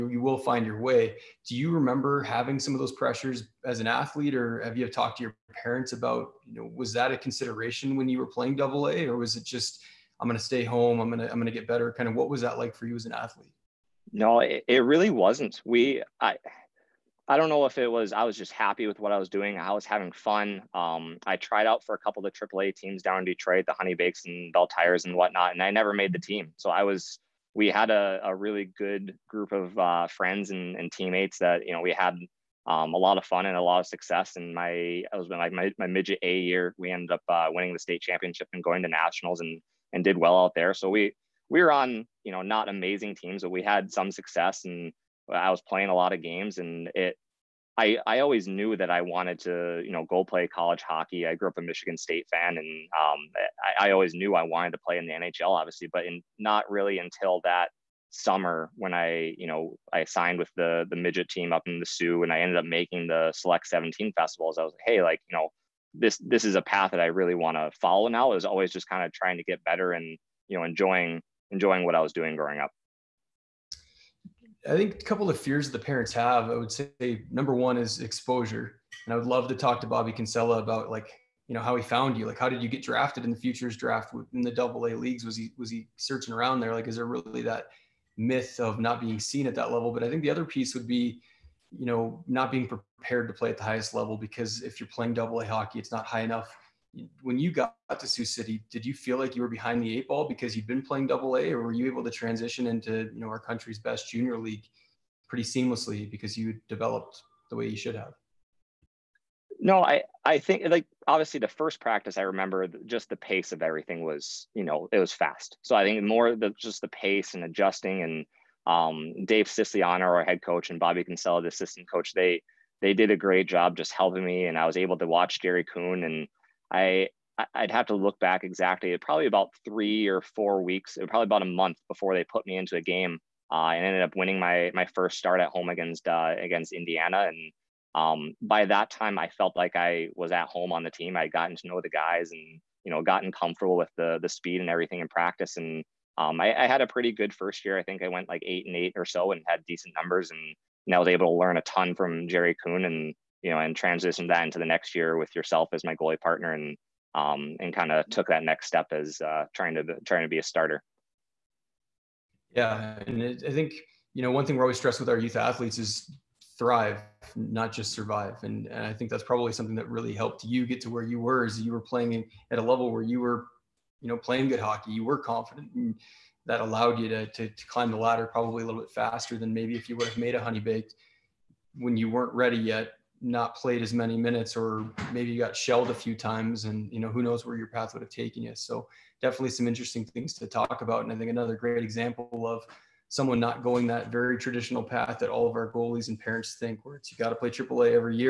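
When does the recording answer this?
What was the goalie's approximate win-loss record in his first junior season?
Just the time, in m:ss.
2:28.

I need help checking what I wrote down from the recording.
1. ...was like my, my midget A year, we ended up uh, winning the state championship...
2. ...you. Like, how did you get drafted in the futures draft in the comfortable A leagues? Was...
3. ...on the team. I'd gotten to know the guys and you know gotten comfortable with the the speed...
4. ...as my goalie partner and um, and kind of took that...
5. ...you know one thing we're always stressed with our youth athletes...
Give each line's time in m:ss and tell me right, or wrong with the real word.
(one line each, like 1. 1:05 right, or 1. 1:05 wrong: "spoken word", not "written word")
1. 0:35 right
2. 1:22 wrong: "double", not "comfortable"
3. 2:20 right
4. 2:35 right
5. 2:44 right.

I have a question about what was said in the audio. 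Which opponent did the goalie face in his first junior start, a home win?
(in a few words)
Indiana.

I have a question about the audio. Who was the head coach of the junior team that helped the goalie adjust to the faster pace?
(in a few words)
Dave Siciliano.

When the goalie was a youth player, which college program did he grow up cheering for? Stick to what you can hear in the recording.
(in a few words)
Michigan State.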